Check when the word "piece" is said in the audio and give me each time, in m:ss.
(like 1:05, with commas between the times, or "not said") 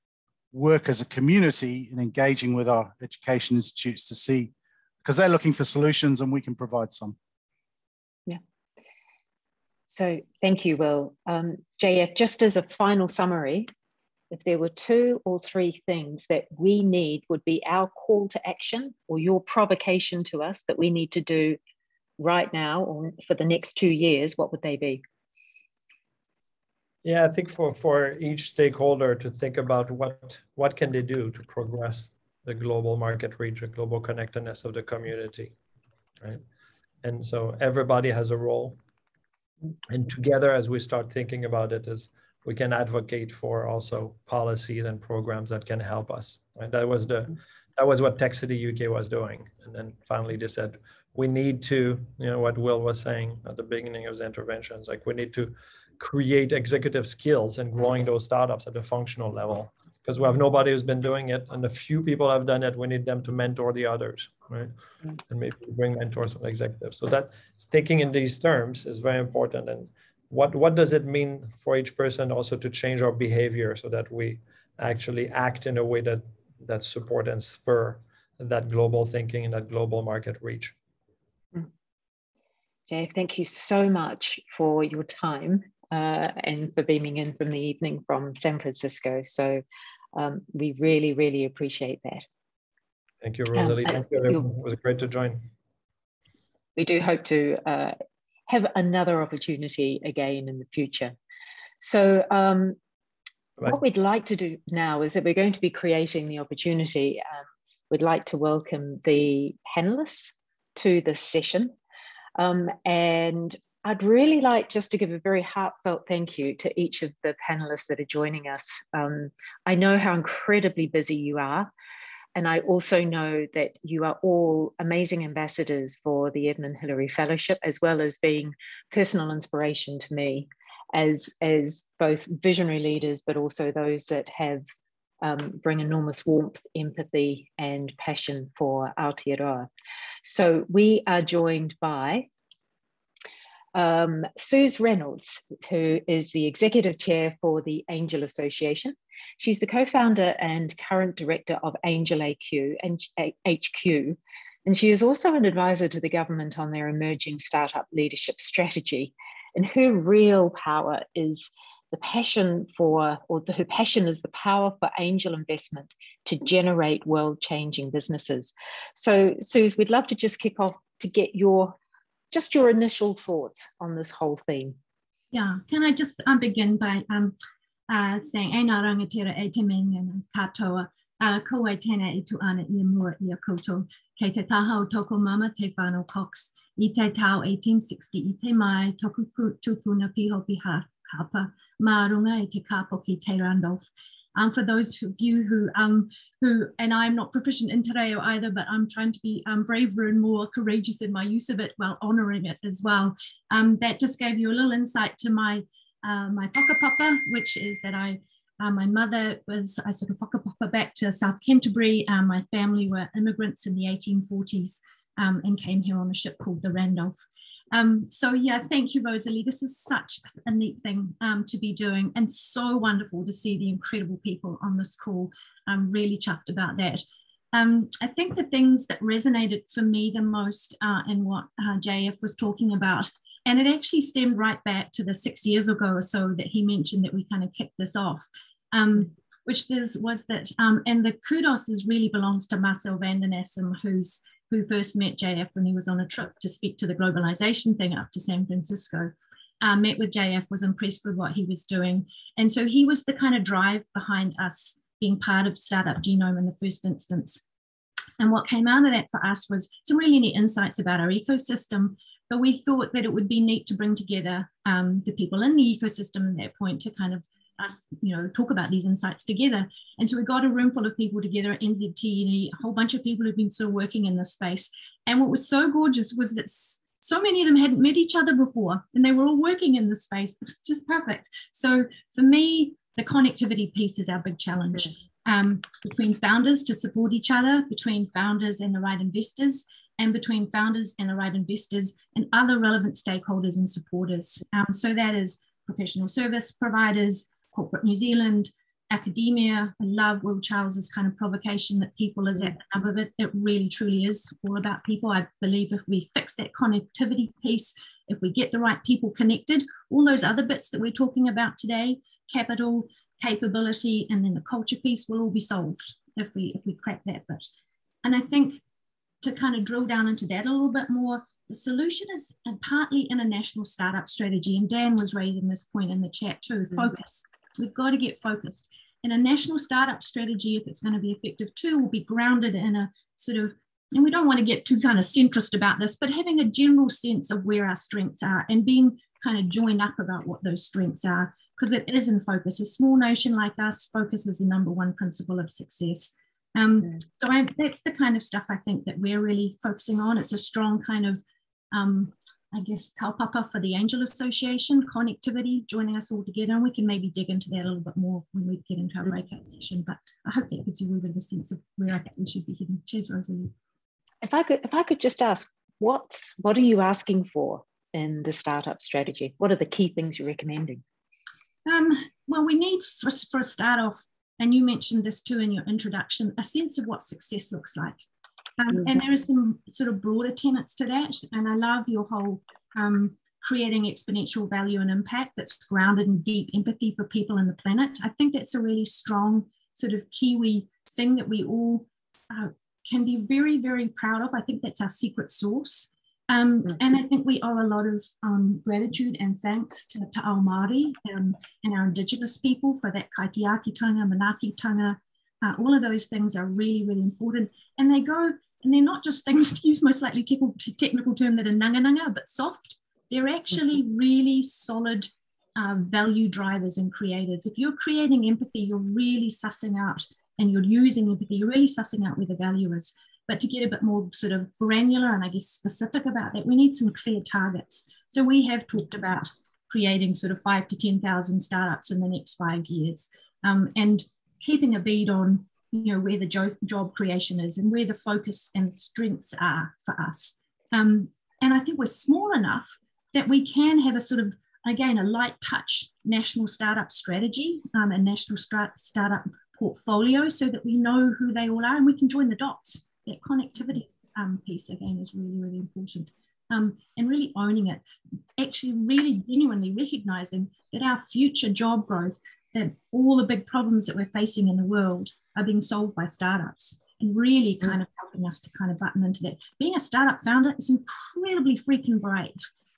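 4:43, 5:07, 5:14, 7:34.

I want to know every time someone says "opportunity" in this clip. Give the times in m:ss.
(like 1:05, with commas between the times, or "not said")
1:39, 1:46.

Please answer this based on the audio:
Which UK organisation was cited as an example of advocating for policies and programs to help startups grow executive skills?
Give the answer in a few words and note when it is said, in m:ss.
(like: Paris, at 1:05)
Tech City UK, at 0:48.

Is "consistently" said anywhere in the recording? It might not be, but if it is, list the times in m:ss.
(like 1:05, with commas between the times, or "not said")
not said.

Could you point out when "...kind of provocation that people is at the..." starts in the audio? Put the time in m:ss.
5:00.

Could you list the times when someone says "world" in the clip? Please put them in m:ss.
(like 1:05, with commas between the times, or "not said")
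2:47, 7:44.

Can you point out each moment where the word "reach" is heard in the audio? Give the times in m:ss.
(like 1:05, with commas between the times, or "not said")
0:33, 1:20.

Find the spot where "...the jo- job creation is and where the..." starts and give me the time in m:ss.
7:16.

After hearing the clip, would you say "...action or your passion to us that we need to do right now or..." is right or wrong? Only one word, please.
wrong.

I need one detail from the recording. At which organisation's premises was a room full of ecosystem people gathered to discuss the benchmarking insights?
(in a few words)
NZTE.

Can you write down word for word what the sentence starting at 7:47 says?
kind of helping us to kind of button into that.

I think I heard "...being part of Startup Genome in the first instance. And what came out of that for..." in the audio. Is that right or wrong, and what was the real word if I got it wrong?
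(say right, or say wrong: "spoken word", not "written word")
right.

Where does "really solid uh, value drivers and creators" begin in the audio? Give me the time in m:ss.
6:53.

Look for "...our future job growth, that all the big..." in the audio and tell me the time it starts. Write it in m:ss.
7:40.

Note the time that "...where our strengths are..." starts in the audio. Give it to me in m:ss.
5:37.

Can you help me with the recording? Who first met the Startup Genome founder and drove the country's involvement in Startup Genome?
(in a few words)
Marcel van den Assum.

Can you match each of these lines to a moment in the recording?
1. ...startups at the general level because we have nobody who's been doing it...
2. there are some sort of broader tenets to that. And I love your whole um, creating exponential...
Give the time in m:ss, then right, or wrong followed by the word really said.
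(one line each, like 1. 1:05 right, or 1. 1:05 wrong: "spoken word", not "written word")
1. 0:58 wrong: "functional", not "general"
2. 6:18 right.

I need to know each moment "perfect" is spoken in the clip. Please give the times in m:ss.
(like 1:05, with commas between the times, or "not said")
4:40.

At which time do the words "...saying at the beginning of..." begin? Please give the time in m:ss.
0:52.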